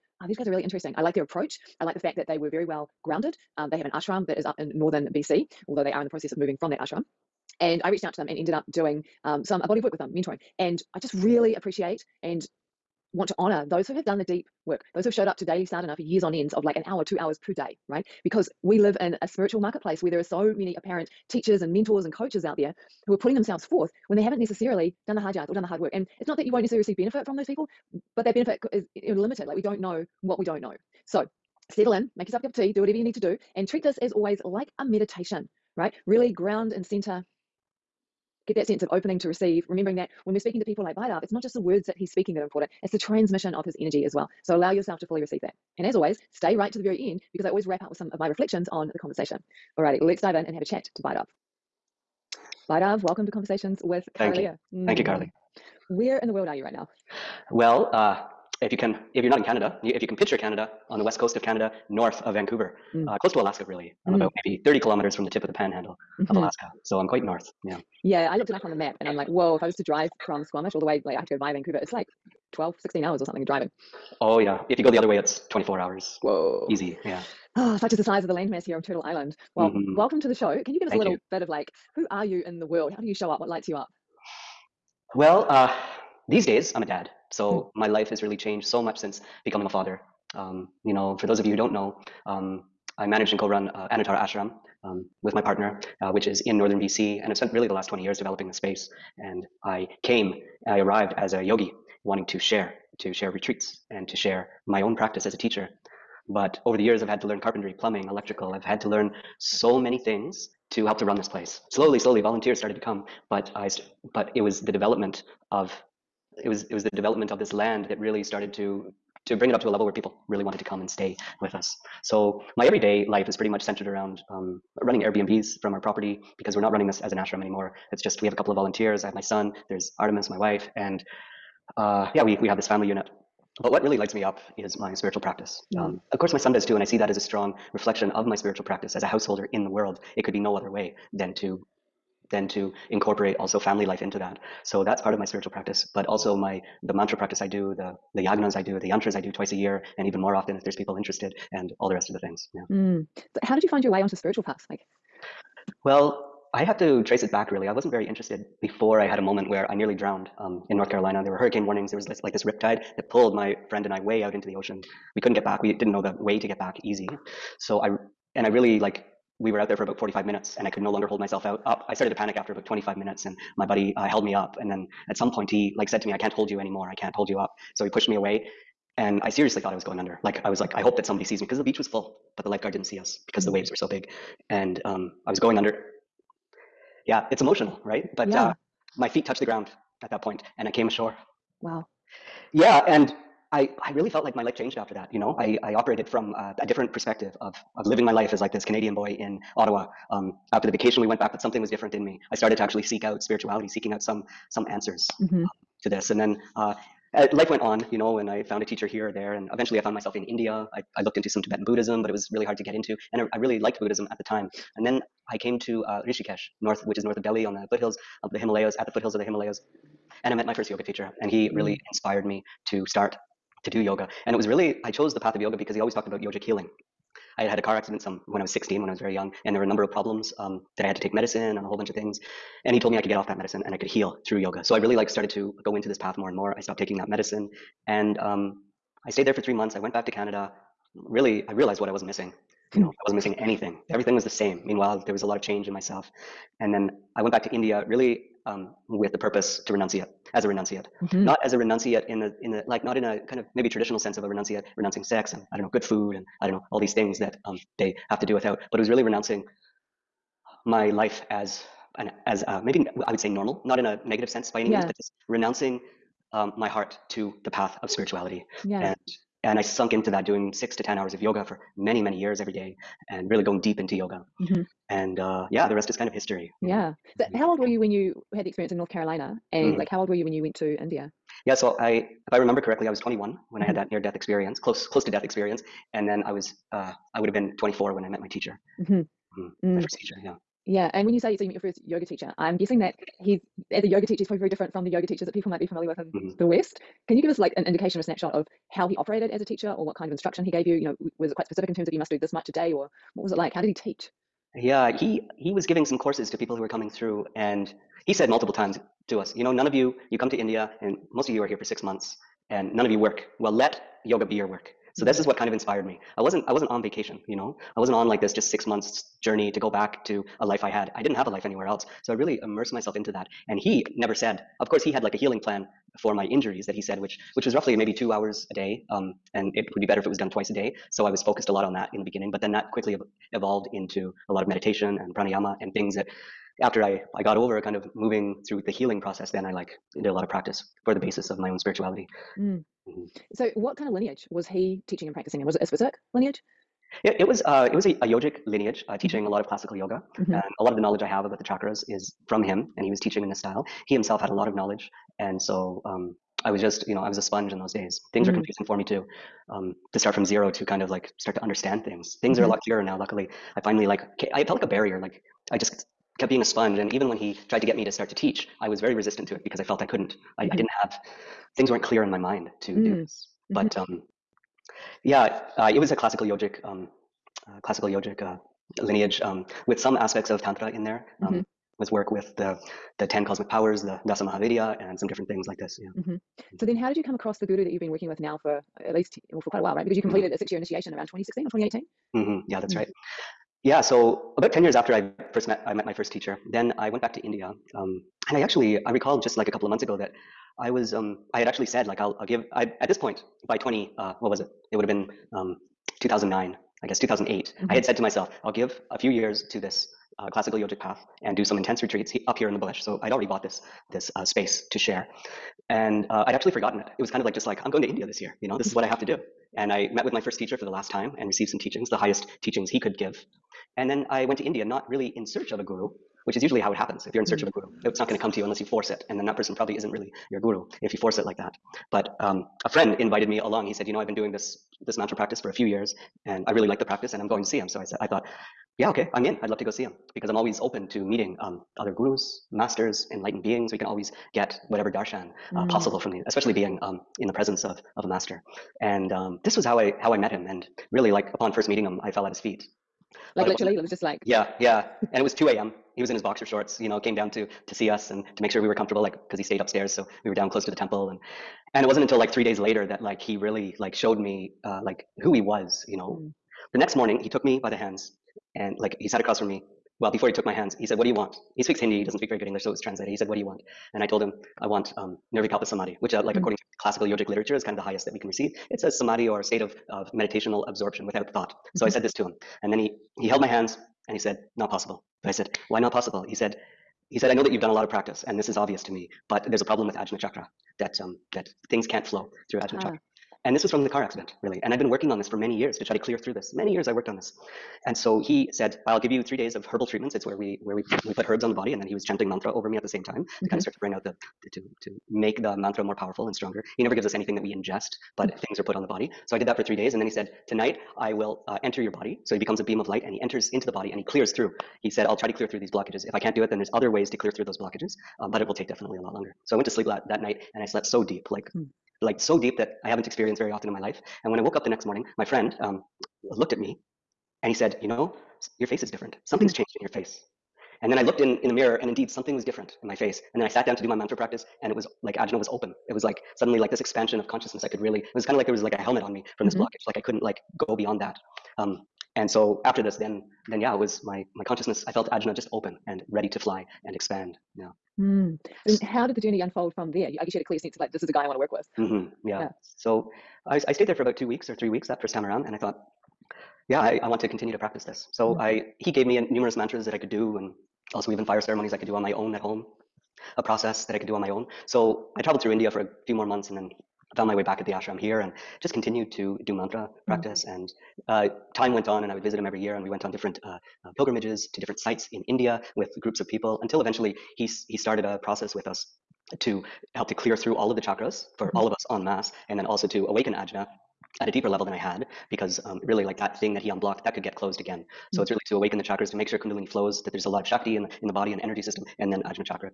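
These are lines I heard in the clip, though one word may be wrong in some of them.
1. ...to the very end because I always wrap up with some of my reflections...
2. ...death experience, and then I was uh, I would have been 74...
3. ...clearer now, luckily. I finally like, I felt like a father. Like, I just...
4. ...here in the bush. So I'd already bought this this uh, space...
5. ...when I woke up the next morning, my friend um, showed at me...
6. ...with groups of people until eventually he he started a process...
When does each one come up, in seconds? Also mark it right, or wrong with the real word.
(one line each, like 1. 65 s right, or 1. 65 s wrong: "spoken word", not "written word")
1. 46 s right
2. 285 s wrong: "24", not "74"
3. 362 s wrong: "barrier", not "father"
4. 412 s right
5. 524 s wrong: "looked", not "showed"
6. 575 s right.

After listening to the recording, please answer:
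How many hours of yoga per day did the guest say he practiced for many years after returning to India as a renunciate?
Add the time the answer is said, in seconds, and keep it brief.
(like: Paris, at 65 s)
6 to 10, at 270 s.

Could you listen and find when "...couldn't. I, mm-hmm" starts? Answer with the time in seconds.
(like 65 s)
369 s.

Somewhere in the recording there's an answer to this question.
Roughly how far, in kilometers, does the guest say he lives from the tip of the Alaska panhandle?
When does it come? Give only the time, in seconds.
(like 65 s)
64 s.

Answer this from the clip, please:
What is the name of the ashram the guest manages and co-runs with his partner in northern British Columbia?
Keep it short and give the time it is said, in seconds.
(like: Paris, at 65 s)
Anuttara Ashram, at 93 s.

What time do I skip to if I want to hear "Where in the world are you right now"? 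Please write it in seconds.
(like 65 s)
55 s.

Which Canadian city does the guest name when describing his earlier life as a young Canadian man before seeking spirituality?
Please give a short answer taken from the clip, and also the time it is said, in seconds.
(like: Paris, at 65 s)
Ottawa, at 199 s.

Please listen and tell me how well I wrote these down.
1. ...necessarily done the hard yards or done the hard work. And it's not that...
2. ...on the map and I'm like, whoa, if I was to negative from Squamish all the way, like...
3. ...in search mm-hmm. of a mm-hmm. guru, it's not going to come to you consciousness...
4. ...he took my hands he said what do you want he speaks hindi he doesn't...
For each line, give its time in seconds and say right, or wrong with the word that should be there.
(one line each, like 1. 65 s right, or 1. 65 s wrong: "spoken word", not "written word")
1. 24 s right
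2. 68 s wrong: "drive", not "negative"
3. 427 s wrong: "unless", not "consciousness"
4. 470 s right.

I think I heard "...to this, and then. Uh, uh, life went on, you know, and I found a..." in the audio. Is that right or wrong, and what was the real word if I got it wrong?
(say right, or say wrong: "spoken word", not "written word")
right.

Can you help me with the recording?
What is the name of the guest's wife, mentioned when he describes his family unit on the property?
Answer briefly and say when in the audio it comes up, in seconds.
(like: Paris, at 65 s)
Artemis, at 129 s.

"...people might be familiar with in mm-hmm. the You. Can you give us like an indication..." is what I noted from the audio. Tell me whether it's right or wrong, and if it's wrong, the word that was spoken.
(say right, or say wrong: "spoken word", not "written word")
wrong: "West", not "You".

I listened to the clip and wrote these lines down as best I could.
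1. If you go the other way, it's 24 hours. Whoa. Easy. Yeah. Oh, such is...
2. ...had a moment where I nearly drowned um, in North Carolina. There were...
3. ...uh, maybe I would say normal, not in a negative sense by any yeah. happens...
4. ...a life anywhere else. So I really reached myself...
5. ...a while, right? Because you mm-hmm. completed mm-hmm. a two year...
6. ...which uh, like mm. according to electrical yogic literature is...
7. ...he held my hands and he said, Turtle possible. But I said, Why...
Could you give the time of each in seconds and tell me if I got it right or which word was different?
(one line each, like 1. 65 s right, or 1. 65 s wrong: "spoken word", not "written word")
1. 74 s right
2. 159 s right
3. 262 s wrong: "means", not "happens"
4. 321 s wrong: "immersed", not "reached"
5. 389 s wrong: "six", not "two"
6. 476 s wrong: "classical", not "electrical"
7. 483 s wrong: "Not", not "Turtle".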